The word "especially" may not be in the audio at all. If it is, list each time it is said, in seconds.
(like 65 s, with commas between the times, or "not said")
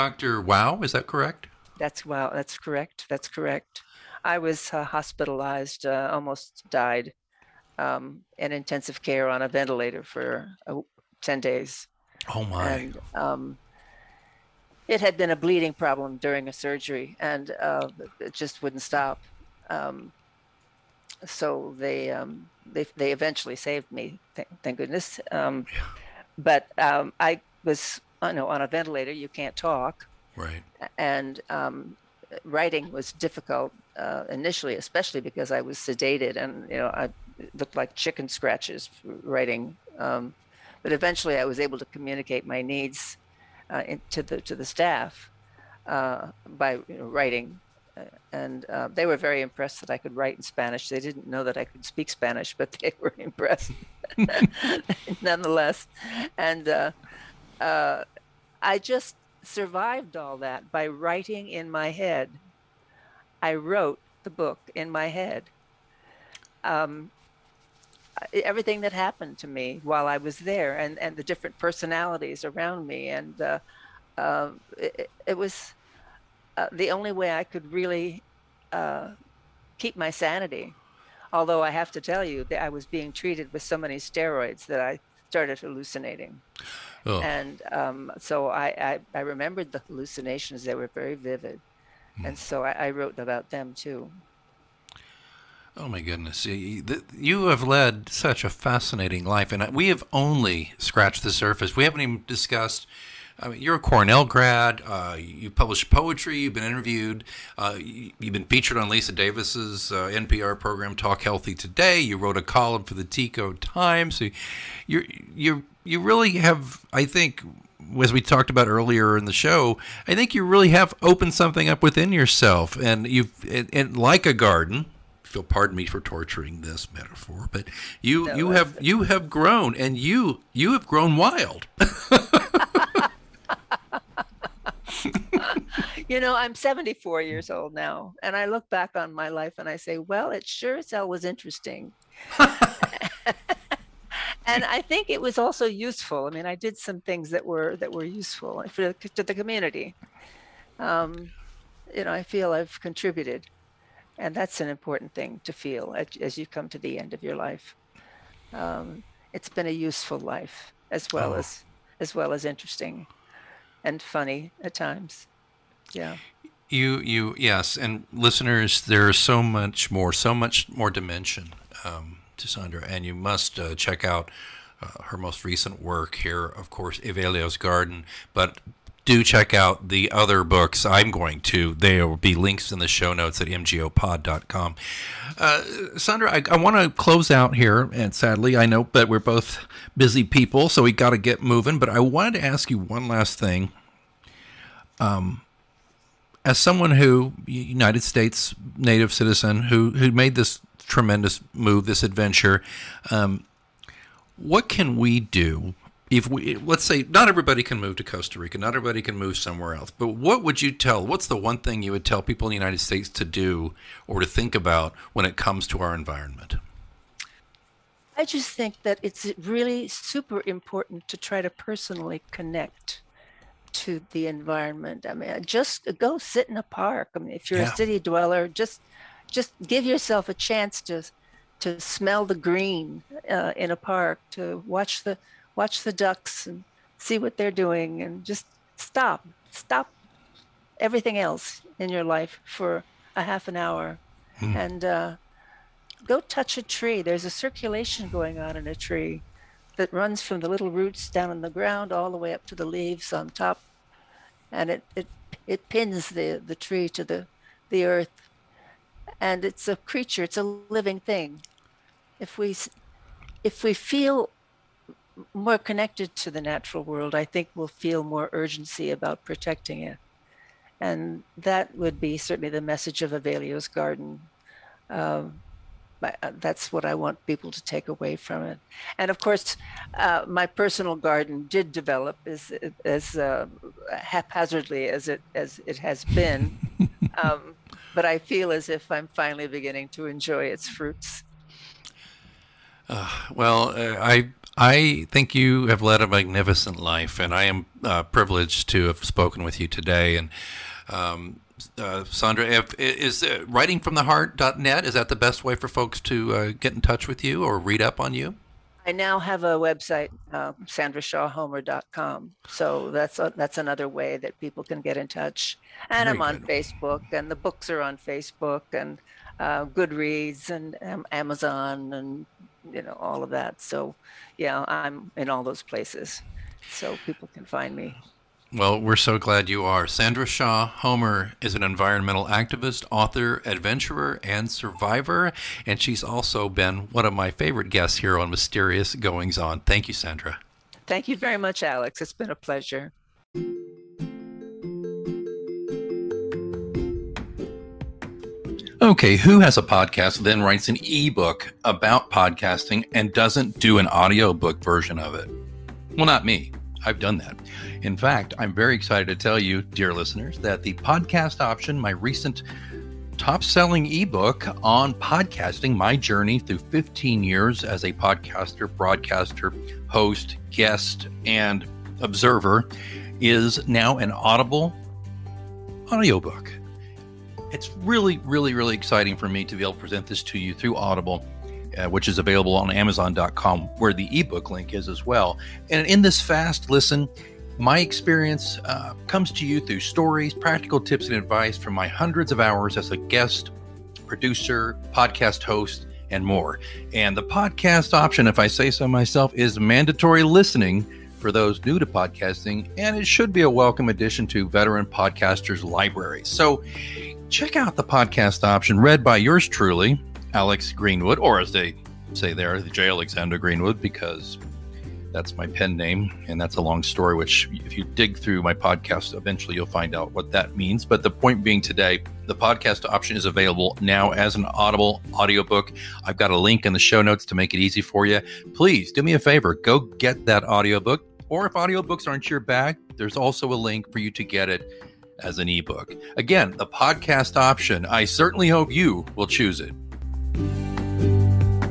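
34 s.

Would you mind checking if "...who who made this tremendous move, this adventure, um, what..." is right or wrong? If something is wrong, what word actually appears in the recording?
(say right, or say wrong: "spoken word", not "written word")
right.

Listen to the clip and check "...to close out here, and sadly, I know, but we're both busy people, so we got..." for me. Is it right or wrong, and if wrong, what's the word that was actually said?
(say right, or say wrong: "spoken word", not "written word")
right.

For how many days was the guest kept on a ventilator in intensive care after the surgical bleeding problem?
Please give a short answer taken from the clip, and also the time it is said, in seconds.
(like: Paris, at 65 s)
10, at 11 s.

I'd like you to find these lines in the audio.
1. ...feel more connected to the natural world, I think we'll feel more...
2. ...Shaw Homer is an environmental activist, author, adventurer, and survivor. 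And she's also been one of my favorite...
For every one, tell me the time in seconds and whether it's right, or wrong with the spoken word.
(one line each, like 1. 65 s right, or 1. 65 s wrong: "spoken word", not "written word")
1. 263 s right
2. 330 s right.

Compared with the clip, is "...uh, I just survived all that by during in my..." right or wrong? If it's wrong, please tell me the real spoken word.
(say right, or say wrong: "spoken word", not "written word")
wrong: "writing", not "during".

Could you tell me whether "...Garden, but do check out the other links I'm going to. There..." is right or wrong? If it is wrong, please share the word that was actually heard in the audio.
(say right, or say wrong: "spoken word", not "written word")
wrong: "books", not "links".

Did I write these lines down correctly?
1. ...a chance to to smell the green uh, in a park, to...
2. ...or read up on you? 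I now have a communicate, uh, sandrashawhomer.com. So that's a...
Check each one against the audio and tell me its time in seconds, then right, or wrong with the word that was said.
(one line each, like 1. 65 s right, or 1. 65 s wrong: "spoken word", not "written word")
1. 230 s right
2. 307 s wrong: "website", not "communicate".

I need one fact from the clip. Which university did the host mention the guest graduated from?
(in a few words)
Cornell.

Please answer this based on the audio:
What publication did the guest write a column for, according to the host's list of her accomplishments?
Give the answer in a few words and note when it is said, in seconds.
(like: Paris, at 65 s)
Tico Times, at 113 s.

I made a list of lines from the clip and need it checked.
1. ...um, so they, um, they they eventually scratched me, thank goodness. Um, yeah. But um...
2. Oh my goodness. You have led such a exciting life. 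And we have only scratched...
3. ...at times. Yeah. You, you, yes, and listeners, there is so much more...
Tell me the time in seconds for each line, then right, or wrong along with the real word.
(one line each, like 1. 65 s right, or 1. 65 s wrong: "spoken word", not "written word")
1. 19 s wrong: "saved", not "scratched"
2. 95 s wrong: "fascinating", not "exciting"
3. 164 s right.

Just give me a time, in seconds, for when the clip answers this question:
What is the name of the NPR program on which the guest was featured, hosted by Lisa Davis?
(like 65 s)
110 s.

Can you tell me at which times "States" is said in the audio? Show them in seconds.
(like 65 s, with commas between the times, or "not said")
198 s, 212 s.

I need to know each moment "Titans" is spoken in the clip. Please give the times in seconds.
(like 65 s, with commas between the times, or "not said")
not said.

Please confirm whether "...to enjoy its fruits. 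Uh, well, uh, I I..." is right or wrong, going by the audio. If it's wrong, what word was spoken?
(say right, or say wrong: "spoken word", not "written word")
right.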